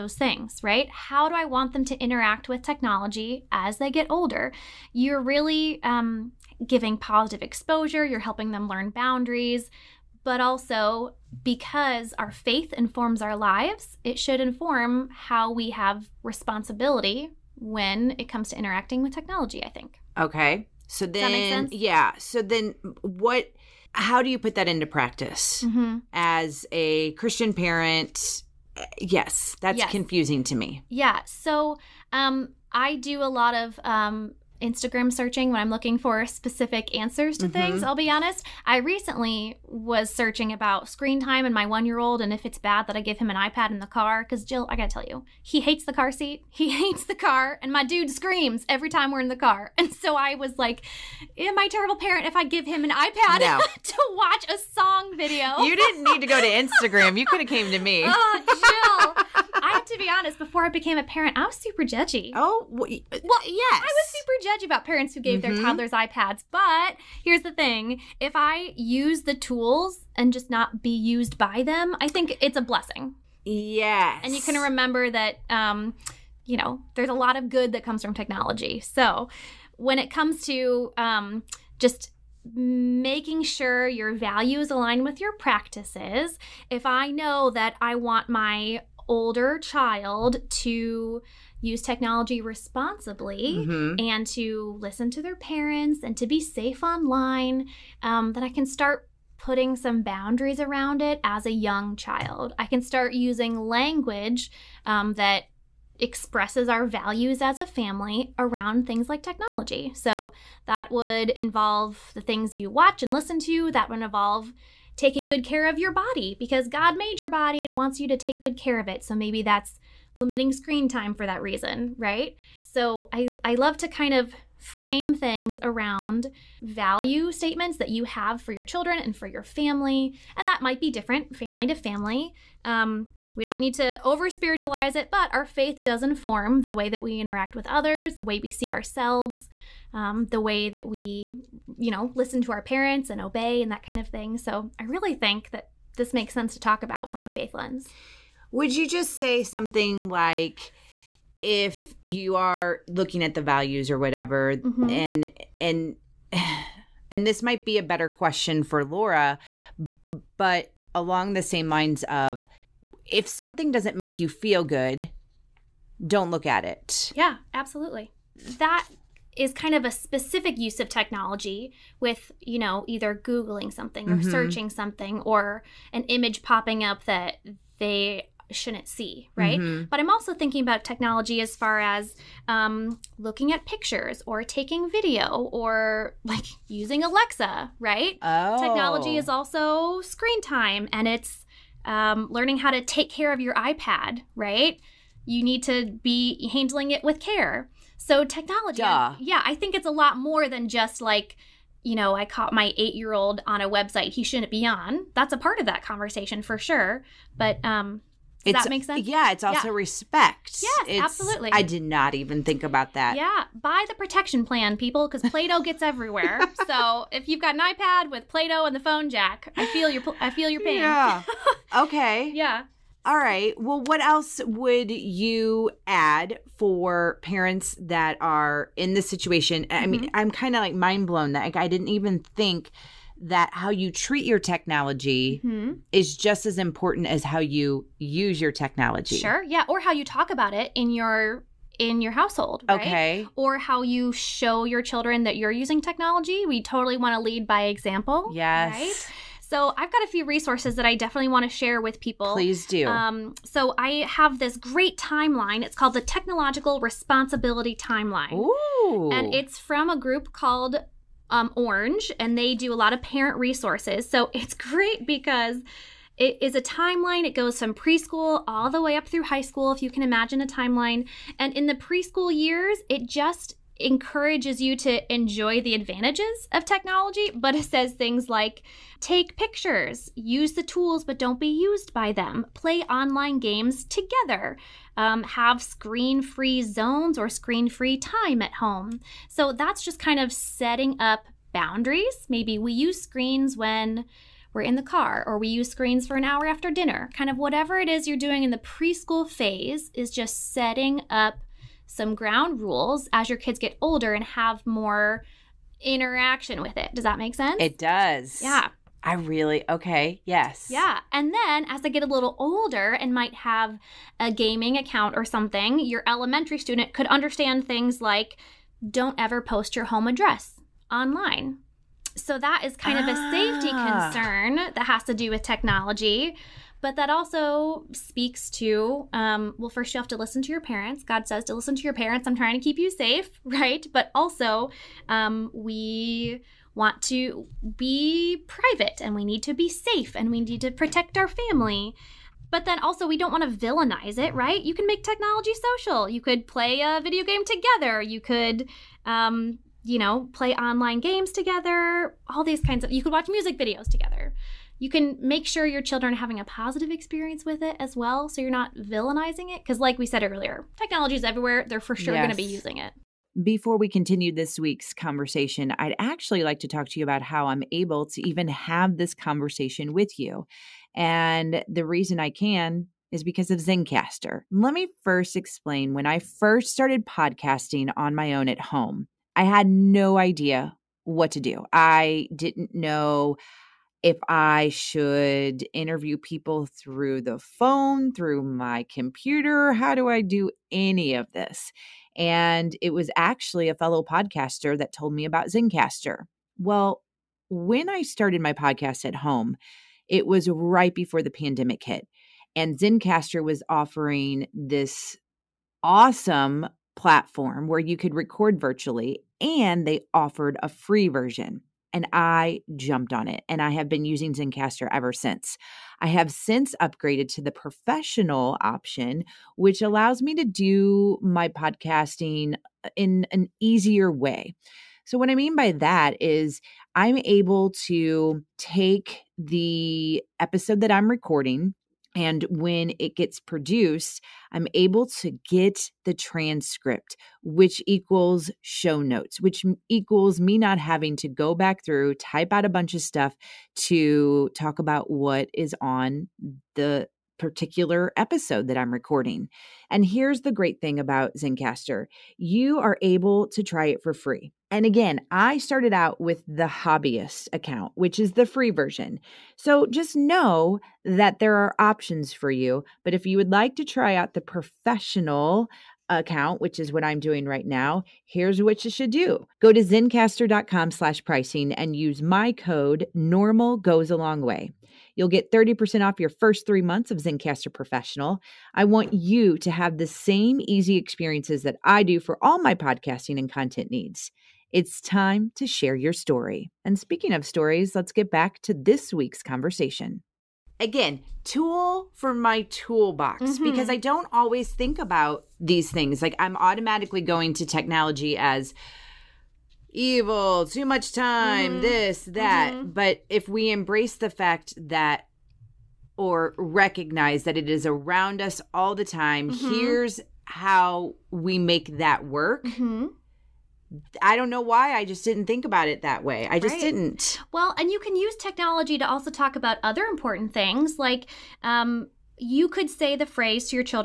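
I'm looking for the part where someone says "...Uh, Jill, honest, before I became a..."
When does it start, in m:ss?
0:58.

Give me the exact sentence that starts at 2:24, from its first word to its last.
So I really think that this makes sense to talk about from a faith lens.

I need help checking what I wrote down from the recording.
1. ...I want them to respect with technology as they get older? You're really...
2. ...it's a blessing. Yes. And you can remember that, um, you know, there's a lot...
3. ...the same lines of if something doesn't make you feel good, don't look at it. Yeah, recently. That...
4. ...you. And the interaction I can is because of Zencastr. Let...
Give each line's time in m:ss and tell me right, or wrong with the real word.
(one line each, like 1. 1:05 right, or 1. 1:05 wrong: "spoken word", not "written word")
1. 0:01 wrong: "interact", not "respect"
2. 1:12 right
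3. 2:41 wrong: "absolutely", not "recently"
4. 6:10 wrong: "reason", not "interaction".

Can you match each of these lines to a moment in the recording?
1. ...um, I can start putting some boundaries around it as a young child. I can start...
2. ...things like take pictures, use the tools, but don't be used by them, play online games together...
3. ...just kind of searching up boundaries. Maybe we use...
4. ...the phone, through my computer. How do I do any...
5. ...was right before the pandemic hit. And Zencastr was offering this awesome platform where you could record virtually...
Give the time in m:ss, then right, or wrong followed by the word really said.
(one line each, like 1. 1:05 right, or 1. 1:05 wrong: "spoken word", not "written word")
1. 1:38 right
2. 4:37 right
3. 4:49 wrong: "setting", not "searching"
4. 6:27 right
5. 6:40 right.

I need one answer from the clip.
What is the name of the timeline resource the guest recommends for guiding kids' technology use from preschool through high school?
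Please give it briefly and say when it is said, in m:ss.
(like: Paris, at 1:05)
Technological Responsibility Timeline, at 4:16.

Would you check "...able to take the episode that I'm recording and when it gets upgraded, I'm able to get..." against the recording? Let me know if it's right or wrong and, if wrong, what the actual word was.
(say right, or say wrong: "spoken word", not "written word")
wrong: "produced", not "upgraded".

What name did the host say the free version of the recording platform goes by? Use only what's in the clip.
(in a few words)
hobbyist account.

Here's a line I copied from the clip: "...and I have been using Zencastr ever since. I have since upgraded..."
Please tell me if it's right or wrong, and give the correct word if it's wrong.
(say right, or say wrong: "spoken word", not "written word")
right.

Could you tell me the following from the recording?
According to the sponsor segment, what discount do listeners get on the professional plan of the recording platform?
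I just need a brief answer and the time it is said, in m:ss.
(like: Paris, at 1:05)
30%, at 7:55.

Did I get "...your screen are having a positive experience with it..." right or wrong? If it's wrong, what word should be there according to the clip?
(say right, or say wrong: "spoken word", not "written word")
wrong: "children", not "screen".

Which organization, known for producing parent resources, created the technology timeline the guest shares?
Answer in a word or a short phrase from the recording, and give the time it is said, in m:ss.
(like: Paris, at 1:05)
Orange, at 4:21.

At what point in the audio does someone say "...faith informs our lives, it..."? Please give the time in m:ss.
0:12.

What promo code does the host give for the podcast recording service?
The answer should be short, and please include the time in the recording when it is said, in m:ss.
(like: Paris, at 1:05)
normal goes a long way, at 7:53.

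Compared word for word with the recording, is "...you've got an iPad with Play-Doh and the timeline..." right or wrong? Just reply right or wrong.
wrong.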